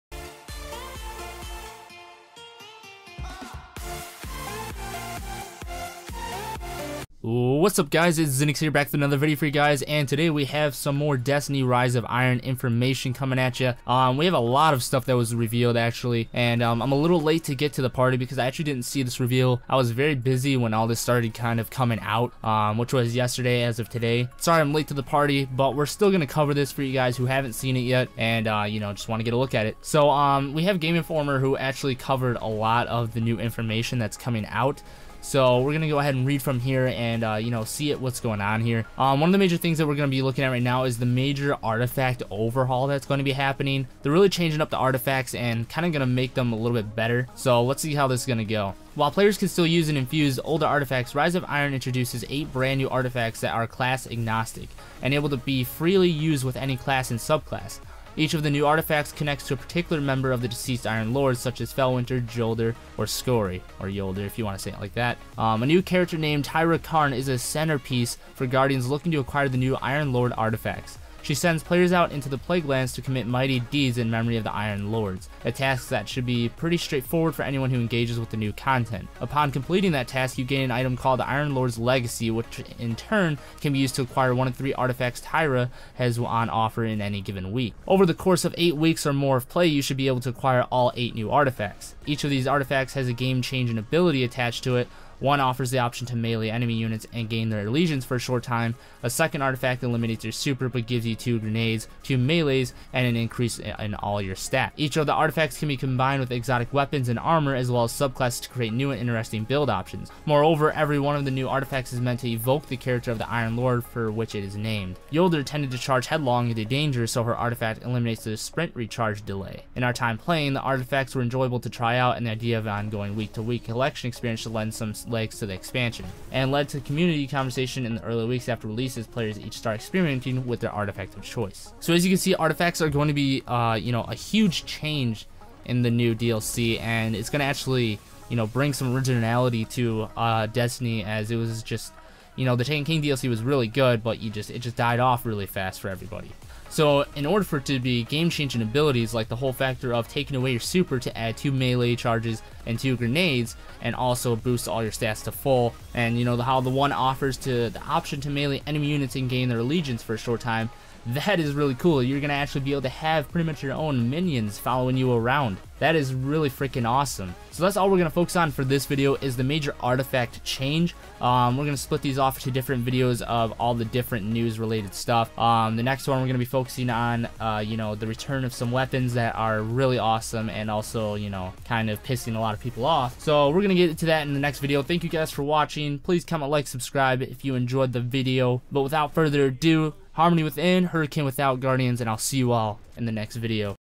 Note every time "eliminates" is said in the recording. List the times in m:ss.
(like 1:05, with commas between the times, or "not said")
1:39, 1:57.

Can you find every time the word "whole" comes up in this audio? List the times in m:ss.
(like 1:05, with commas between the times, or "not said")
2:29.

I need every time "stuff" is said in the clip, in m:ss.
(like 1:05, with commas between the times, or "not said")
0:14, 2:54.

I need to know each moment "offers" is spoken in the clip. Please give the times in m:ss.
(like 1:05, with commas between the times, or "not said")
1:26, 1:35, 2:36.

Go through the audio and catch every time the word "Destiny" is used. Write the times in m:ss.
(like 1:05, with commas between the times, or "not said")
0:11, 2:20.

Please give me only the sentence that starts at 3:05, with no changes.
Please comment, like, subscribe if you enjoyed the video.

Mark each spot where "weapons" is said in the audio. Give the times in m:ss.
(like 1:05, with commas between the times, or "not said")
1:46, 2:58.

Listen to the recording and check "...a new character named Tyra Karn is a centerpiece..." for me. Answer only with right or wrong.
right.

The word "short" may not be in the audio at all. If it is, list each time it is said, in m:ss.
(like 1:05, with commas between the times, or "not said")
1:38, 2:40.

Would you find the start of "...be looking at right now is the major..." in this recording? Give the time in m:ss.
0:40.